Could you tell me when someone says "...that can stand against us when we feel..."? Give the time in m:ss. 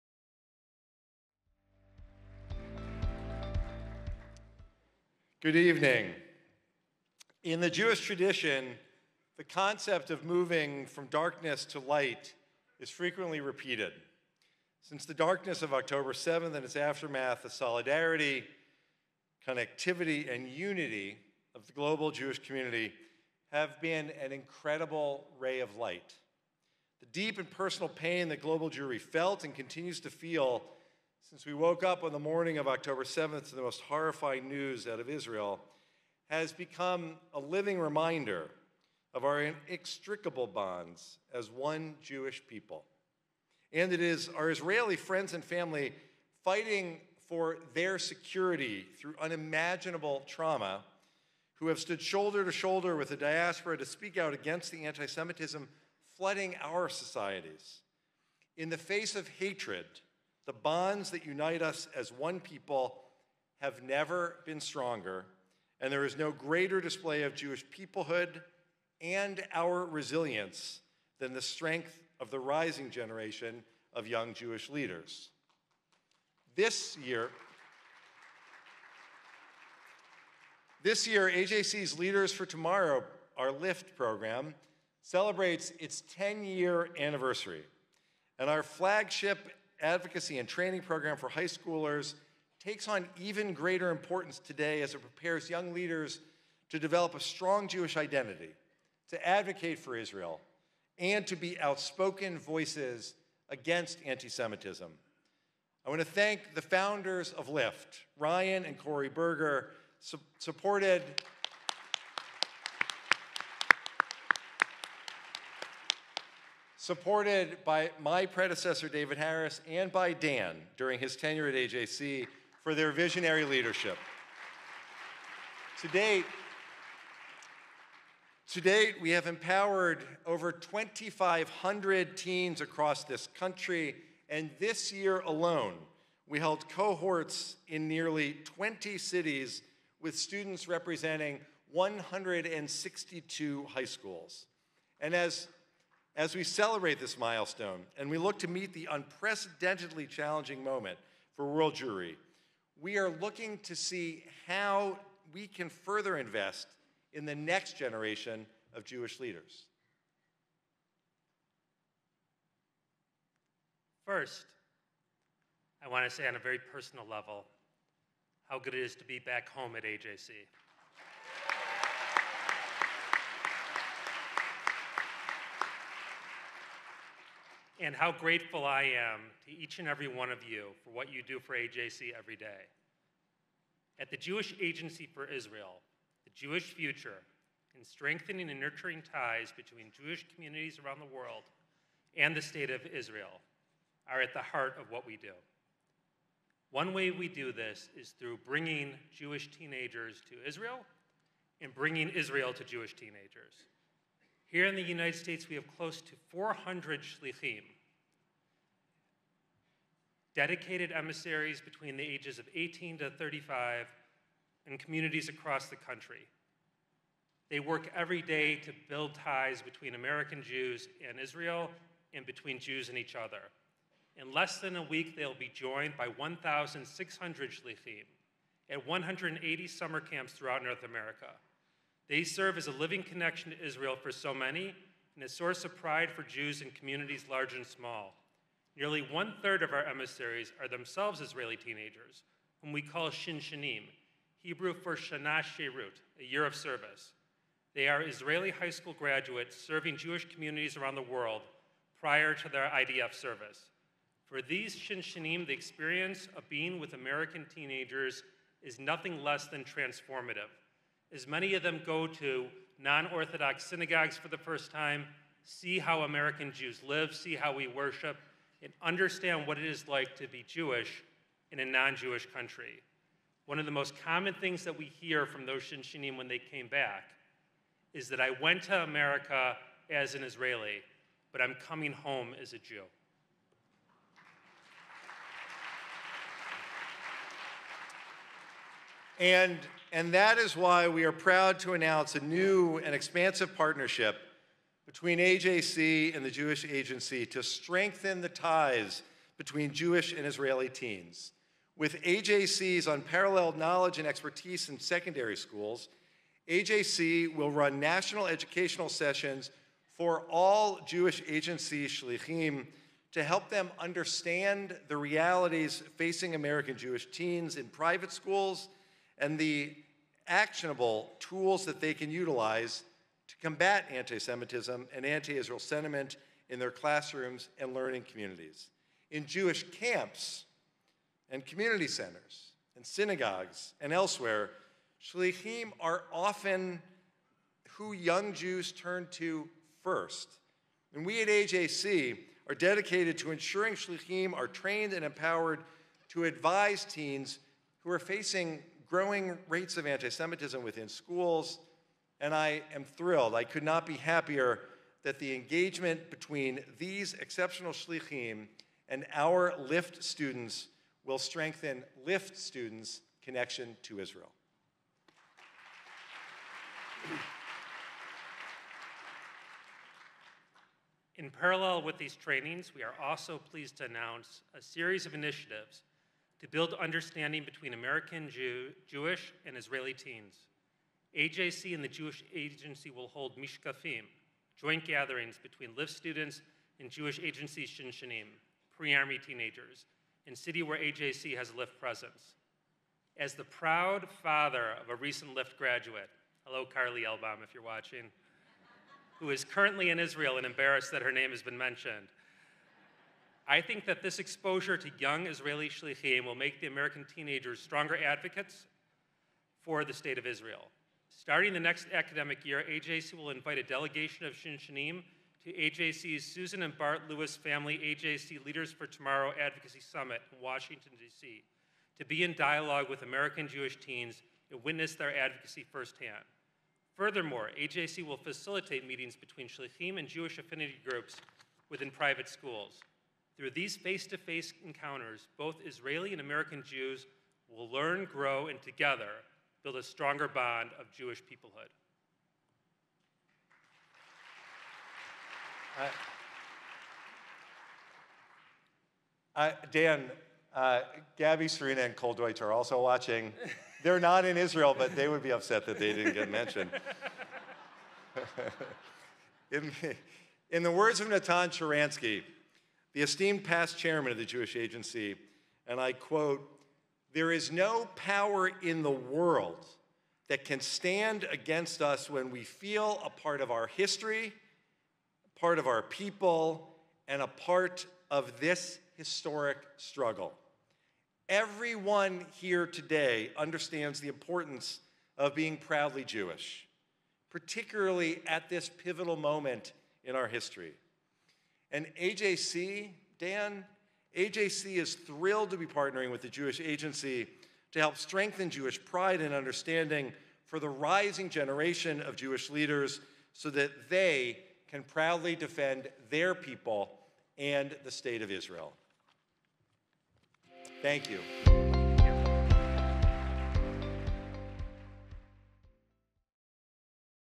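7:50.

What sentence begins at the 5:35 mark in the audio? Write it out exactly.
Shlichim are often who young Jews turn to first.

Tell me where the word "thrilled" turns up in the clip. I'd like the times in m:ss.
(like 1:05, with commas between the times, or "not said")
5:52, 8:14.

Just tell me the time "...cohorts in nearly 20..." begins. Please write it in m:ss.
2:16.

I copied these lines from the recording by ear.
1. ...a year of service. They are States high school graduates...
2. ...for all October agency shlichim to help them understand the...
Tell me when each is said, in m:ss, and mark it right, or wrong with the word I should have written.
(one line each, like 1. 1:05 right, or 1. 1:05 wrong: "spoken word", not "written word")
1. 4:06 wrong: "Israeli", not "States"
2. 5:09 wrong: "Jewish", not "October".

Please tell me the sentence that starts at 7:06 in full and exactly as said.
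Furthermore, AJC will facilitate meetings between Shlichim and Jewish affinity groups within private schools.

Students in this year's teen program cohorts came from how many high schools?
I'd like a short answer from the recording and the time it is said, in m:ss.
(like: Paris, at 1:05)
162, at 2:21.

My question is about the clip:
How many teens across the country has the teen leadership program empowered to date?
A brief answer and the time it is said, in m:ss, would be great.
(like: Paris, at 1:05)
2,500, at 2:10.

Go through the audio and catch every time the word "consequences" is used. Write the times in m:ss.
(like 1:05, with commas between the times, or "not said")
not said.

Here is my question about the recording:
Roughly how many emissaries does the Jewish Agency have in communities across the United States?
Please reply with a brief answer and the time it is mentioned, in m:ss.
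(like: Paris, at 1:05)
400, at 3:25.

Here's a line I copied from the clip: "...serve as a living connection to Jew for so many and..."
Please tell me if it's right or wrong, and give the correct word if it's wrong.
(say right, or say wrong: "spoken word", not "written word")
wrong: "Israel", not "Jew".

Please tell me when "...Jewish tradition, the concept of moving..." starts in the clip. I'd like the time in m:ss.
0:07.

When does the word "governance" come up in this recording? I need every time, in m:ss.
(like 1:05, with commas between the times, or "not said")
not said.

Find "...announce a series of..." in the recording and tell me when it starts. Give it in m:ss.
6:13.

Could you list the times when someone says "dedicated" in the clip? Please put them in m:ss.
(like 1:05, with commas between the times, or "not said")
3:30, 5:42.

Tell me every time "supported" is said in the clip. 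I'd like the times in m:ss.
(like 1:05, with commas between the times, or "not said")
1:50, 1:56.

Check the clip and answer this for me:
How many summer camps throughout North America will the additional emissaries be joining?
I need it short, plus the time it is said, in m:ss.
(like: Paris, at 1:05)
180, at 3:48.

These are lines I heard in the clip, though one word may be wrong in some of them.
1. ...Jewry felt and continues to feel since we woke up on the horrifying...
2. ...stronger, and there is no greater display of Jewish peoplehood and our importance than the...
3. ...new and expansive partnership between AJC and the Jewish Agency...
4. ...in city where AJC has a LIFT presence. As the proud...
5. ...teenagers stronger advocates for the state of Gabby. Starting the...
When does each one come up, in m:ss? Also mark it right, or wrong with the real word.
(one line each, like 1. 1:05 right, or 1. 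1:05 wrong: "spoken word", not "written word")
1. 0:28 wrong: "morning", not "horrifying"
2. 1:04 wrong: "resilience", not "importance"
3. 4:52 right
4. 6:30 right
5. 6:47 wrong: "Israel", not "Gabby".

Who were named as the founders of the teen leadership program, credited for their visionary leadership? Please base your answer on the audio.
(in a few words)
Ryan and Corey Berger.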